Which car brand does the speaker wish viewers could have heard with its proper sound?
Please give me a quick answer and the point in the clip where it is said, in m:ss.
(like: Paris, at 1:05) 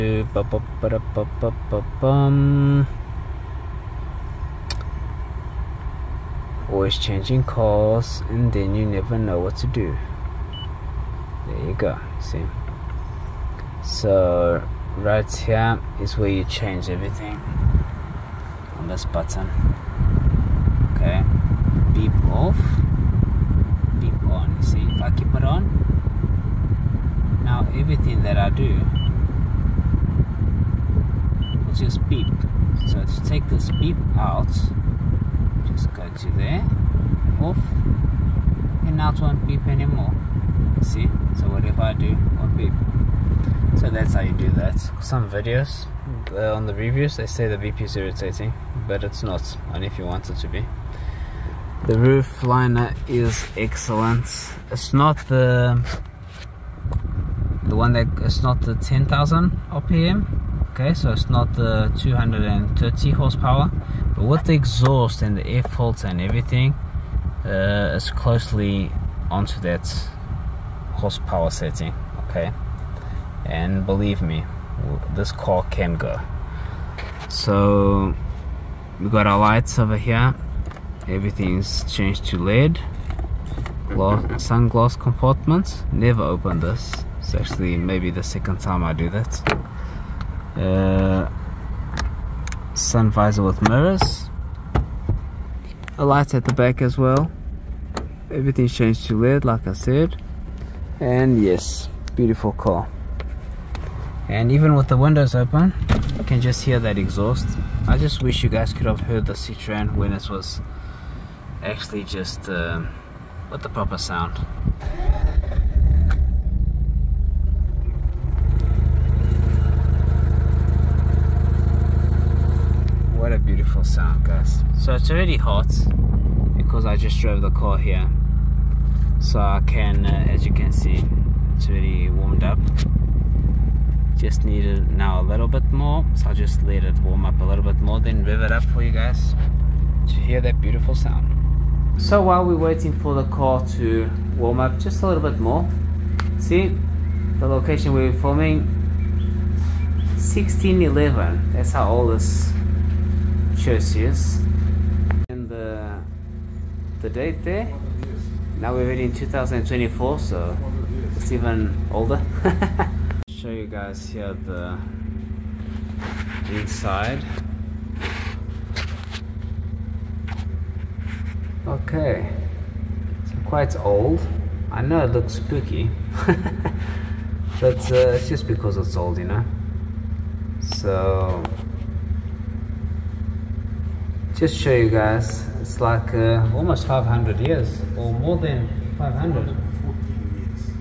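Citroen, at 1:49.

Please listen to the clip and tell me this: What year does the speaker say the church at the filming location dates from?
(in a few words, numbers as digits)
1611.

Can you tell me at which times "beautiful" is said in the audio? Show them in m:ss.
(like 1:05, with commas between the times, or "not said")
1:42, 2:03, 2:20.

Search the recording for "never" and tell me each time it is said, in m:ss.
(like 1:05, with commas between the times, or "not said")
0:08, 1:25.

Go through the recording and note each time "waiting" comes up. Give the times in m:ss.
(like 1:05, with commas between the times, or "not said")
2:22.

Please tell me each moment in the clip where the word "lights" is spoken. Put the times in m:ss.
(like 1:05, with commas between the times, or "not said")
1:19, 1:36.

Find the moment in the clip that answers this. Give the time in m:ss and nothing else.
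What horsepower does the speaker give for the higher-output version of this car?
1:01.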